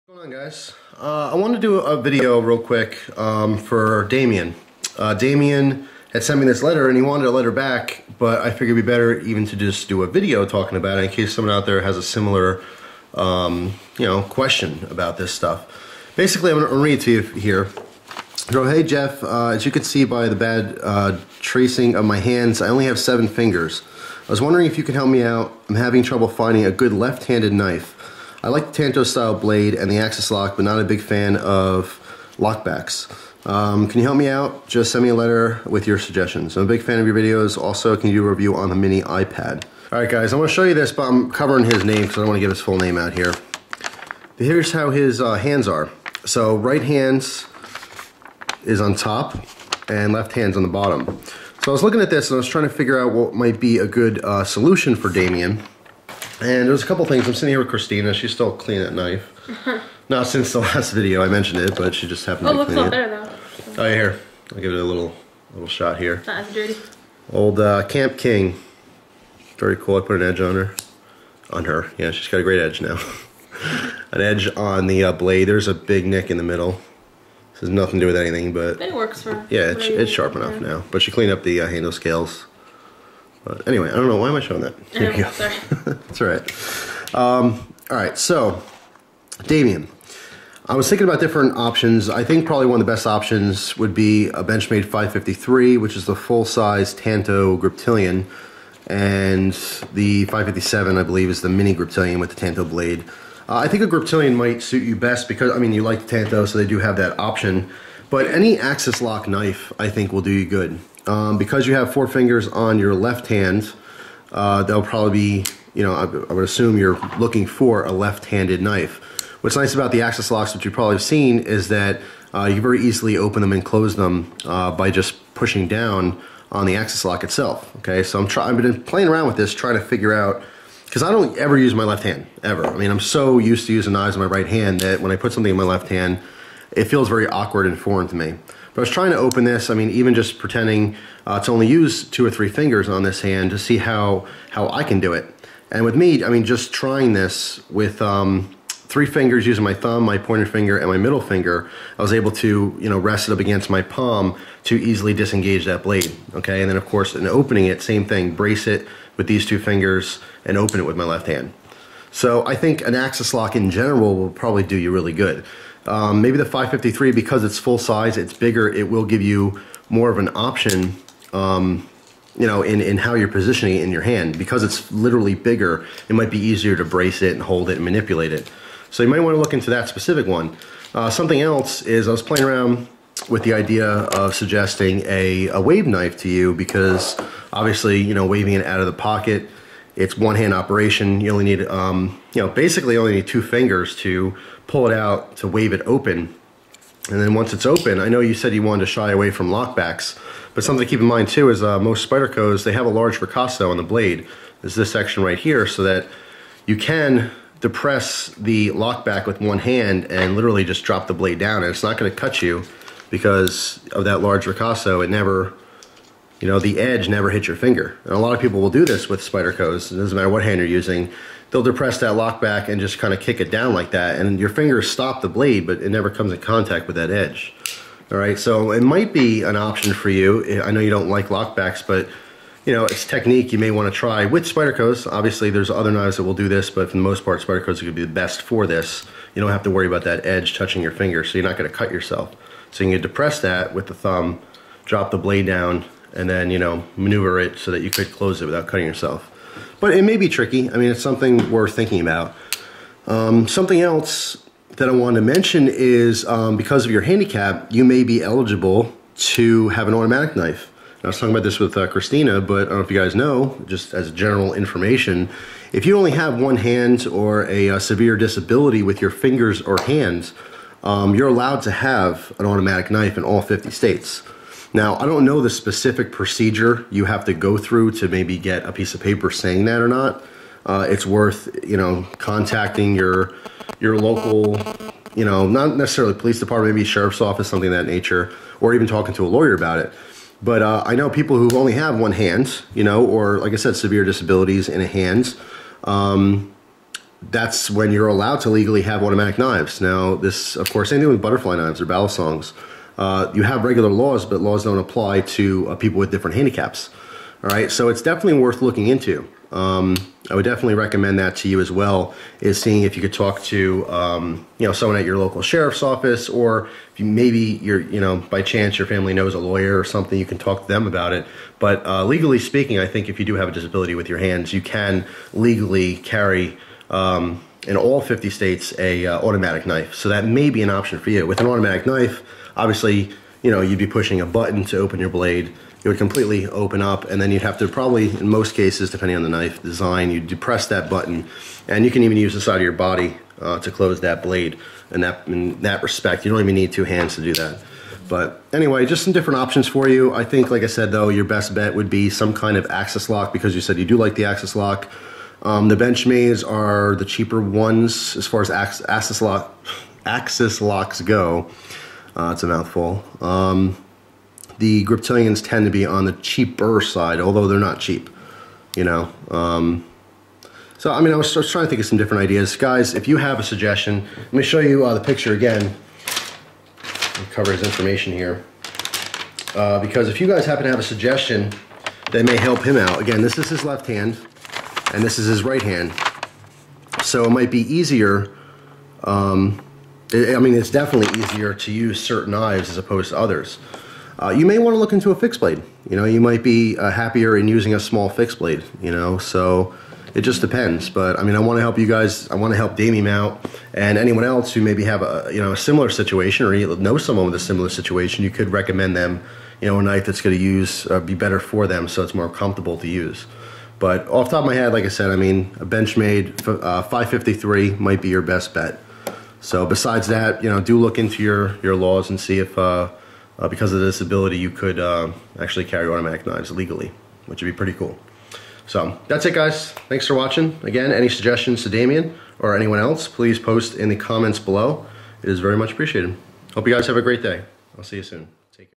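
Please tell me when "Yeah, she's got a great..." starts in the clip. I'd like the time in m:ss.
1:11.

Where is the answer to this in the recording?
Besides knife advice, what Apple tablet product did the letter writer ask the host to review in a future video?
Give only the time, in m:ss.
0:38.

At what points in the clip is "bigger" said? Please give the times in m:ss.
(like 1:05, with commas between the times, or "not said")
2:48, 2:55.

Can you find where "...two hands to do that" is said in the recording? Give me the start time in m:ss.
5:46.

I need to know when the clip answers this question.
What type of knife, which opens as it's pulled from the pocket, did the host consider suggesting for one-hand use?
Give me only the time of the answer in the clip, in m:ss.
3:05.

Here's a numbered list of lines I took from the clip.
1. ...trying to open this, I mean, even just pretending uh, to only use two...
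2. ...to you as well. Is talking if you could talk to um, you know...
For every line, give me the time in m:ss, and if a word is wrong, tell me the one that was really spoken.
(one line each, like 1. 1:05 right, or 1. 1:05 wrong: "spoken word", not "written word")
1. 2:18 right
2. 5:11 wrong: "seeing", not "talking".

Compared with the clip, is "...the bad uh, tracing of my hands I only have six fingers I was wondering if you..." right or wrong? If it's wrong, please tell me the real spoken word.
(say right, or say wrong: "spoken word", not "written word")
wrong: "seven", not "six".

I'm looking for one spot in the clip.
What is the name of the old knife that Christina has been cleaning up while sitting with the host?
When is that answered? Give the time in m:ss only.
1:07.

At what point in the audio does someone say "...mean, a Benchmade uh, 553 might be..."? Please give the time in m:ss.
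6:55.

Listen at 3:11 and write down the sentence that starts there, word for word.
You only need, um, you know, basically only need two fingers to pull it out, to wave it open.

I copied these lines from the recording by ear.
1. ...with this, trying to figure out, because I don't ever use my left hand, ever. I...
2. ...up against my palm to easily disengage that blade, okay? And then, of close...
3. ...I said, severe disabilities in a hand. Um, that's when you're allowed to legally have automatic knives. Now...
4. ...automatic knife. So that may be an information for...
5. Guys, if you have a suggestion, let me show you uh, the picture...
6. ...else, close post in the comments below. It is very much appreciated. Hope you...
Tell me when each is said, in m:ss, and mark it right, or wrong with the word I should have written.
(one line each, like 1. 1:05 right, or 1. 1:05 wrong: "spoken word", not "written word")
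1. 2:09 right
2. 2:33 wrong: "course", not "close"
3. 4:53 right
4. 5:29 wrong: "option", not "information"
5. 6:12 right
6. 7:12 wrong: "please", not "close".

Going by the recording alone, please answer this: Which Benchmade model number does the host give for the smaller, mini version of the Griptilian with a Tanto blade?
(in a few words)
557.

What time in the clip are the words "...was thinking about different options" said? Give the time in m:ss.
1:30.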